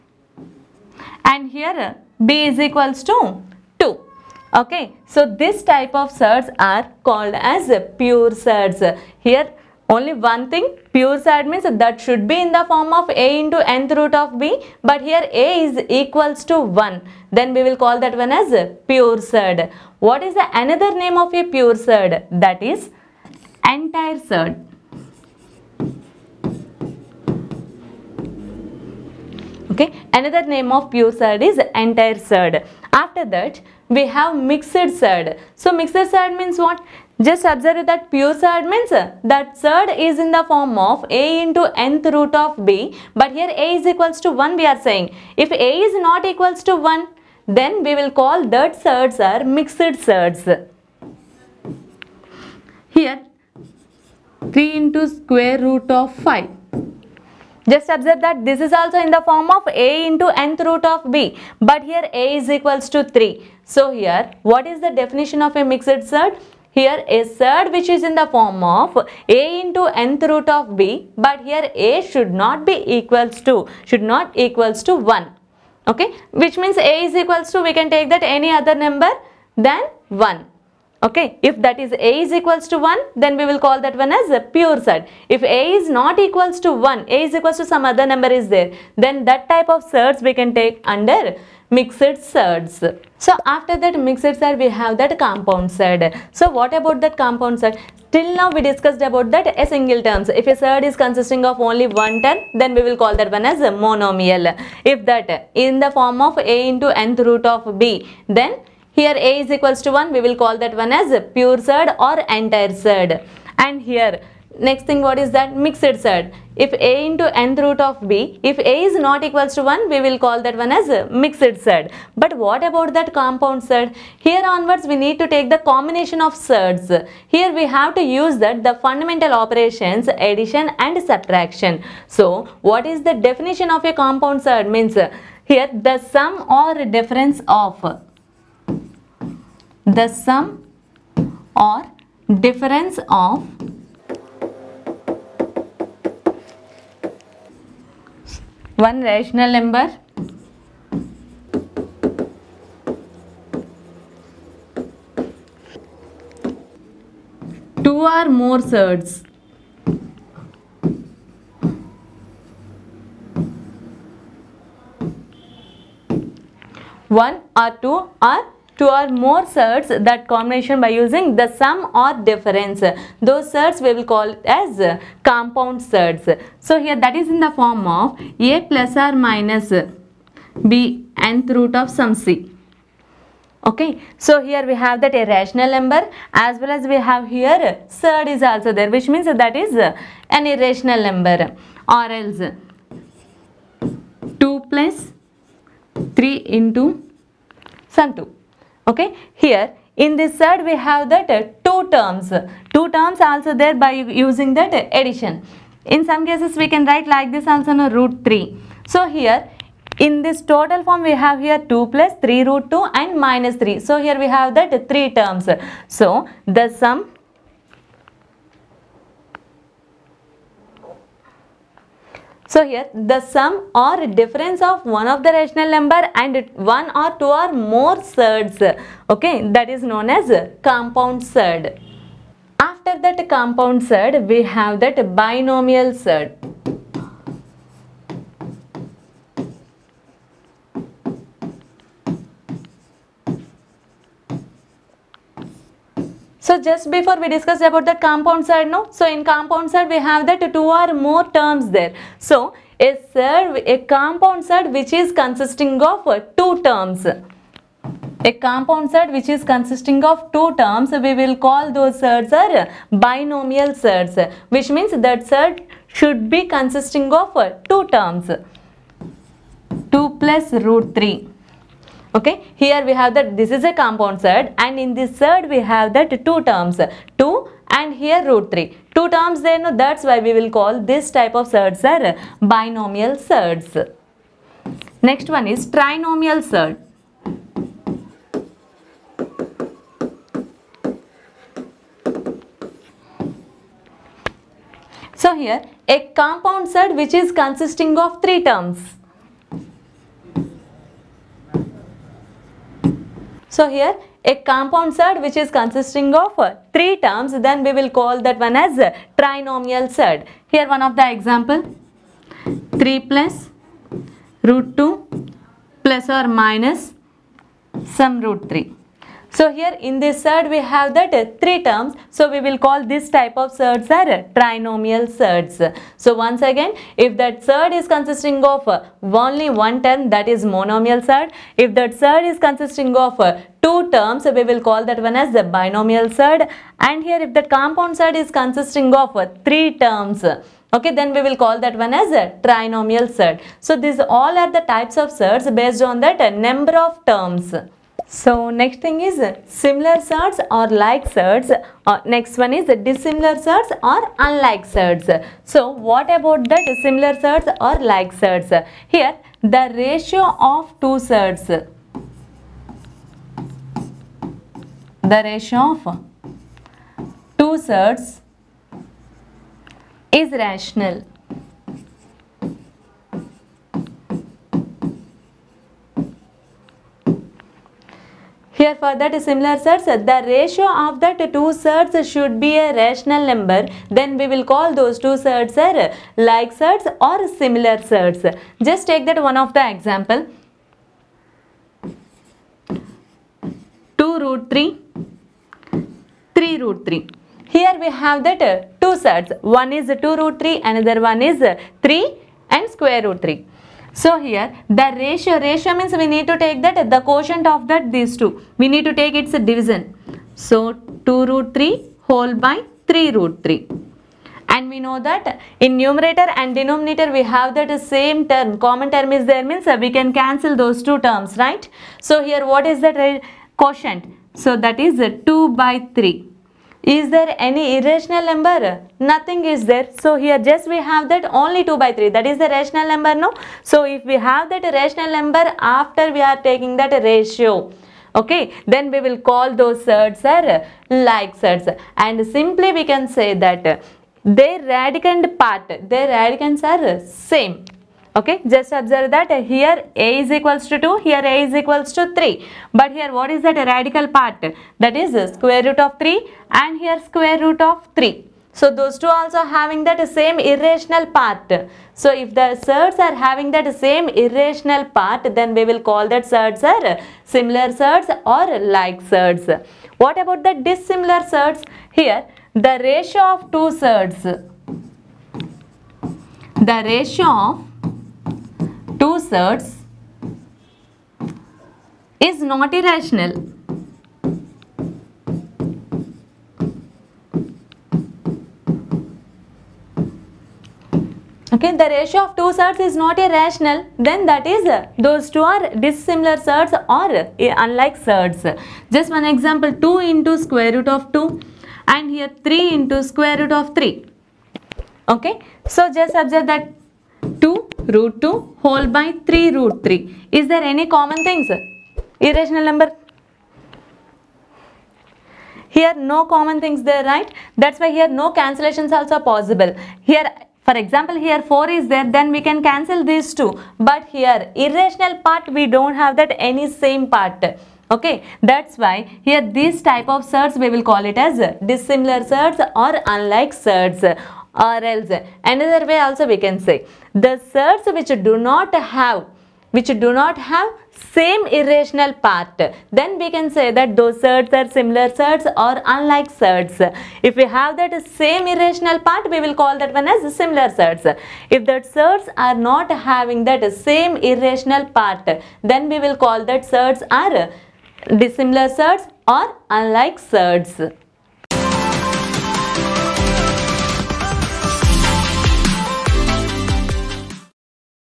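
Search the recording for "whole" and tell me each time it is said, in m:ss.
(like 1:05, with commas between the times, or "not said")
6:52, 8:28.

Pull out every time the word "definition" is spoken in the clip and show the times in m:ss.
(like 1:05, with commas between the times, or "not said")
1:04, 2:13.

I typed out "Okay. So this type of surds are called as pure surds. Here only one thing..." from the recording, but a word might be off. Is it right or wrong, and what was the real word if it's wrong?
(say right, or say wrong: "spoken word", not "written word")
right.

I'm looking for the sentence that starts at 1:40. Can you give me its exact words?
If a surd is consisting of only one term, then we will call that one as a monomial.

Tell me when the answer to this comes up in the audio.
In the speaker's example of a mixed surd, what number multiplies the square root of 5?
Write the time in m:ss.
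0:54.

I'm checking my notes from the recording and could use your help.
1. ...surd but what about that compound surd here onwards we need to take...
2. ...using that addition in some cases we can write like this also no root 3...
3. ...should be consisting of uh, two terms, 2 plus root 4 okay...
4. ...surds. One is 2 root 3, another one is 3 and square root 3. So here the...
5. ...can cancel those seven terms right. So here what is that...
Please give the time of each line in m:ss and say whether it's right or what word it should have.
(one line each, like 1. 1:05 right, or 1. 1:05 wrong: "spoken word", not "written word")
1. 2:01 right
2. 3:24 right
3. 4:25 wrong: "3", not "4"
4. 6:39 right
5. 6:59 wrong: "two", not "seven".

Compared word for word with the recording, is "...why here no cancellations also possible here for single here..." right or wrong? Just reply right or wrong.
wrong.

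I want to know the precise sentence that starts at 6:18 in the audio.
Here for that similar surds, the ratio of that two surds should be a rational number.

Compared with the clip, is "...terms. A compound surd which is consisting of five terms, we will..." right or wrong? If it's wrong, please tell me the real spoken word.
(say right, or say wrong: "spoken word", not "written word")
wrong: "two", not "five".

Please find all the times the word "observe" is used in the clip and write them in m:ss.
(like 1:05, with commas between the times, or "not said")
0:37, 0:57, 7:28, 8:26.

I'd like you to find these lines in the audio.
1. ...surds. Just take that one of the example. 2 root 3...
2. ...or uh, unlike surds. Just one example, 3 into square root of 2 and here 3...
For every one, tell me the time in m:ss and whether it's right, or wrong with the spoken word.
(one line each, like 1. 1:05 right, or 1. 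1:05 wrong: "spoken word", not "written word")
1. 6:27 right
2. 8:16 wrong: "2", not "3".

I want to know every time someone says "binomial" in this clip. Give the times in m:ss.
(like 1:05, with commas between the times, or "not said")
3:55, 4:22, 4:42, 5:35.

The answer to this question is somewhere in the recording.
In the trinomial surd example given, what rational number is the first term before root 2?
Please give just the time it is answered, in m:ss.
5:12.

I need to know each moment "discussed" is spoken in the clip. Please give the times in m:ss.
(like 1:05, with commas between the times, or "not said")
1:38, 4:07.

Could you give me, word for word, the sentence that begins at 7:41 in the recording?
So if the surds are having that same irrational part, then we will call that surds are similar surds or like surds.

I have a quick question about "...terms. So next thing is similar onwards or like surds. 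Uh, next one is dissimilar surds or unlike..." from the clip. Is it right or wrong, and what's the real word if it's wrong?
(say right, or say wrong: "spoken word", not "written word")
wrong: "surds", not "onwards".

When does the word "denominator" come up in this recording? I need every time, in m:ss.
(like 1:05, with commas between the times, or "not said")
6:56.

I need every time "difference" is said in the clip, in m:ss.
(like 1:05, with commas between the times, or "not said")
2:16, 2:22, 2:52, 3:44.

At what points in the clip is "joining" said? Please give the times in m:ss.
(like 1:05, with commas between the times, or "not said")
not said.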